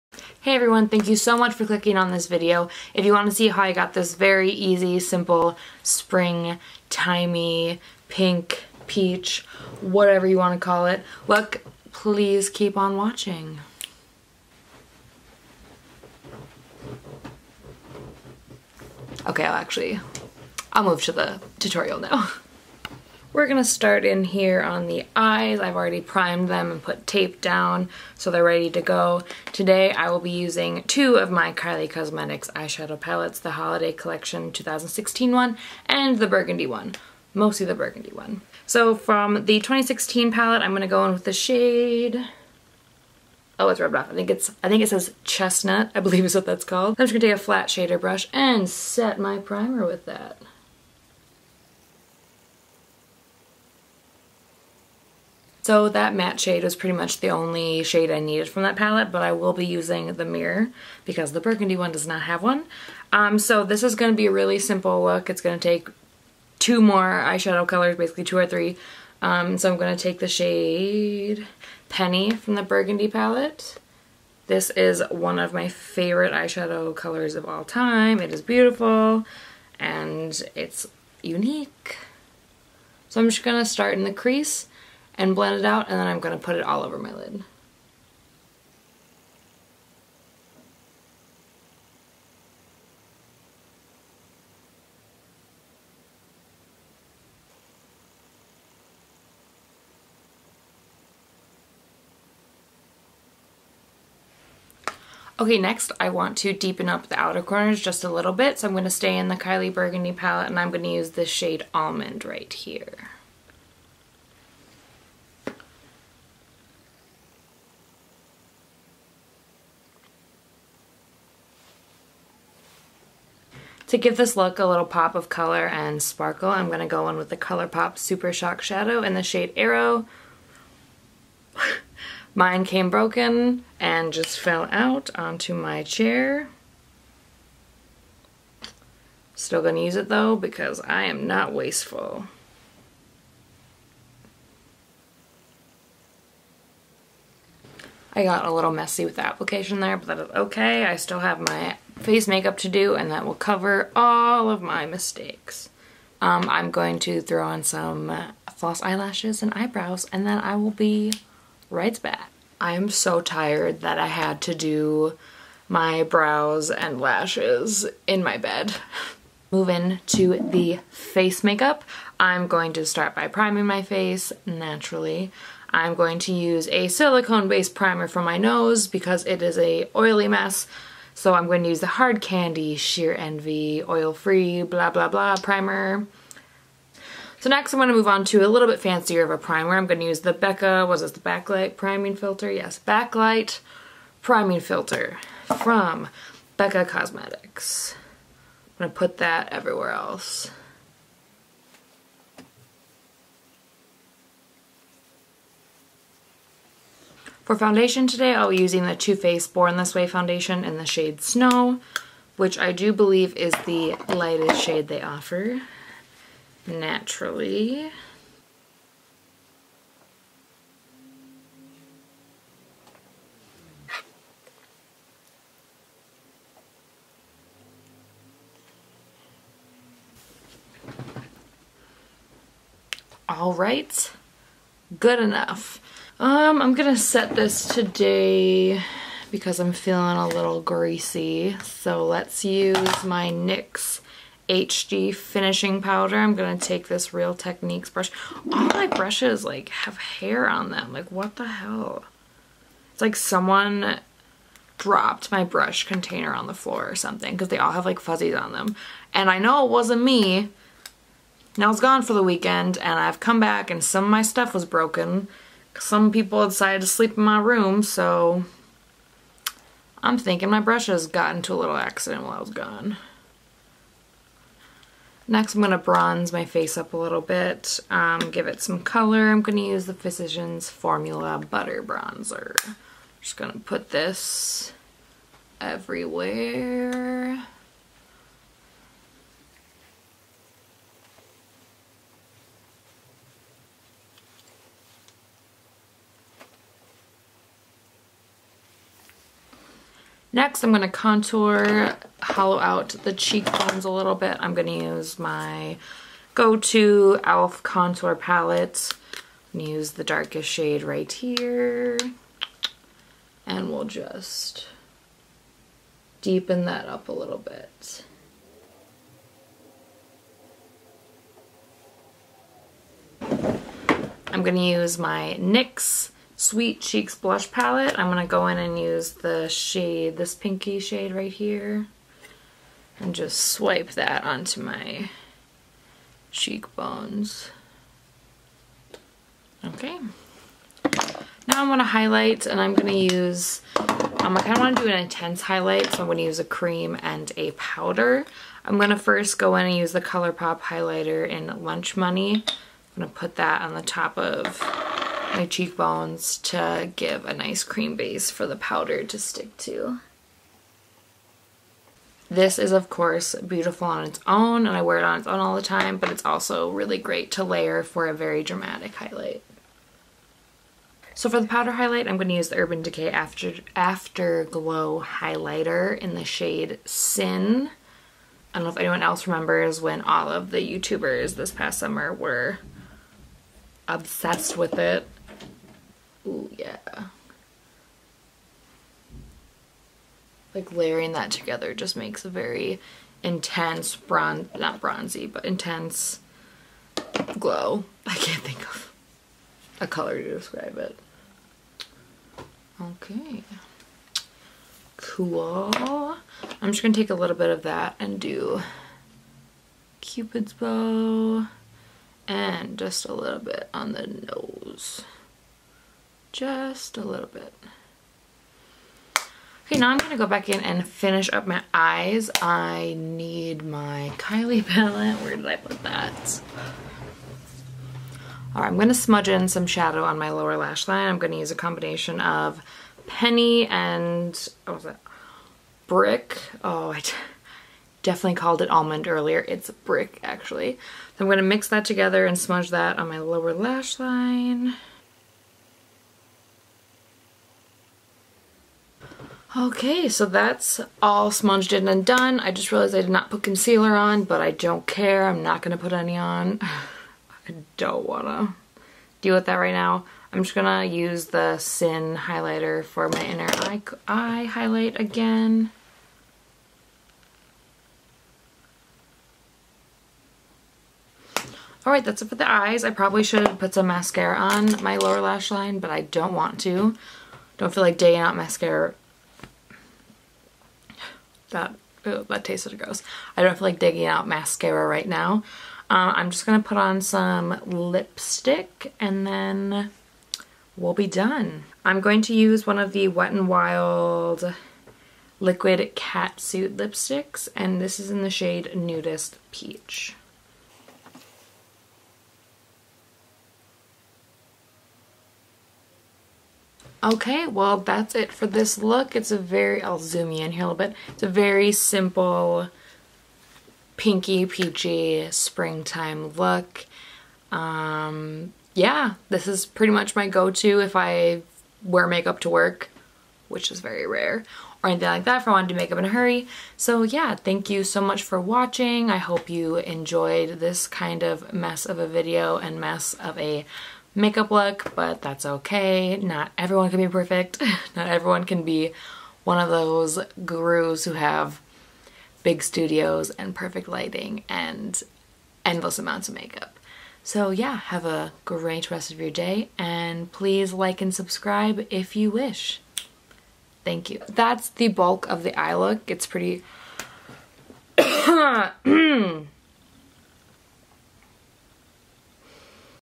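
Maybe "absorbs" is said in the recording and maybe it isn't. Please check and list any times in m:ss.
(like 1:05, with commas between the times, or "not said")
not said.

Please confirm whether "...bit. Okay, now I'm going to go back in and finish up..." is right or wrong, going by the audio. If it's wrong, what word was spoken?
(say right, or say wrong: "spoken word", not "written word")
right.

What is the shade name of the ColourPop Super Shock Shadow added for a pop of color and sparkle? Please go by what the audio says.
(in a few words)
Arrow.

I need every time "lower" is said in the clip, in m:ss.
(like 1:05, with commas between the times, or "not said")
7:10, 7:23, 7:54.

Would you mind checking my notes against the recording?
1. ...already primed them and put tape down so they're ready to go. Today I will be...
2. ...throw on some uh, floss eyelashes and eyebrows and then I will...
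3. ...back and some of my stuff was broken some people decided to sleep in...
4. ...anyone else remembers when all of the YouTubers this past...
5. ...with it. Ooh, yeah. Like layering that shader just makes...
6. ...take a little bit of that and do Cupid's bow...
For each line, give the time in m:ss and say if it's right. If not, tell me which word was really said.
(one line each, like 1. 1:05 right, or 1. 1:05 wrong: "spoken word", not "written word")
1. 0:25 right
2. 2:37 right
3. 4:23 right
4. 6:18 right
5. 6:24 wrong: "together", not "shader"
6. 6:46 right.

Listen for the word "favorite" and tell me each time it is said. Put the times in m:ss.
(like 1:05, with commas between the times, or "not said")
1:15.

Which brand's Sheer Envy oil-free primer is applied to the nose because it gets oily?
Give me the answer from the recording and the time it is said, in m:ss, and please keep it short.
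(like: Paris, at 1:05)
Hard Candy, at 3:01.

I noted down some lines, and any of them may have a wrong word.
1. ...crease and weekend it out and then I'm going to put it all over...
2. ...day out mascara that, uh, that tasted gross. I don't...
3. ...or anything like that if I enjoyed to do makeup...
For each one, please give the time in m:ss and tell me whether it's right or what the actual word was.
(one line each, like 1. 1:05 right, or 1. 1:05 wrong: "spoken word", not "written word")
1. 1:24 wrong: "blend", not "weekend"
2. 7:57 right
3. 8:44 wrong: "wanted", not "enjoyed".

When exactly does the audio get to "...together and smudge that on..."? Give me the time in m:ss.
7:21.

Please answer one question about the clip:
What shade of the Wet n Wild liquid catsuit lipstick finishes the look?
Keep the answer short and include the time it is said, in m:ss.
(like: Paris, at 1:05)
Nudist Peach, at 8:18.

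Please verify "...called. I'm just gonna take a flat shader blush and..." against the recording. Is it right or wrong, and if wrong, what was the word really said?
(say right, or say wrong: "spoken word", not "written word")
wrong: "brush", not "blush".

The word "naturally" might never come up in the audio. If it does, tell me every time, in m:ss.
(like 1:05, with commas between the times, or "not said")
2:54, 3:36.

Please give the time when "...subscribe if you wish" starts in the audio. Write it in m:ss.
9:11.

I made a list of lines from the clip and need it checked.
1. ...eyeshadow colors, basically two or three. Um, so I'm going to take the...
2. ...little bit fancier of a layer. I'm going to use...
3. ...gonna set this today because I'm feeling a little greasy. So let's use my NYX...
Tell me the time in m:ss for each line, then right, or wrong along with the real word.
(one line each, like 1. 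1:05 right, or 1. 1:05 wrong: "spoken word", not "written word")
1. 1:07 right
2. 3:08 wrong: "primer", not "layer"
3. 3:56 right.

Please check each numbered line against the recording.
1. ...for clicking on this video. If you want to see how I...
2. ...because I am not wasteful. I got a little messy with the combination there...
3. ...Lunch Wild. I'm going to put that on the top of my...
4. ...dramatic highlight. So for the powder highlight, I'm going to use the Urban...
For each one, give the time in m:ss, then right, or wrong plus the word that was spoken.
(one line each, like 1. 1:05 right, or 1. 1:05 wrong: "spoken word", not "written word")
1. 0:01 right
2. 2:20 wrong: "application", not "combination"
3. 5:51 wrong: "Money", not "Wild"
4. 6:08 right.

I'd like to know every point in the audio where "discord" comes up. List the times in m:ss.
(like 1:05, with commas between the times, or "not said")
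not said.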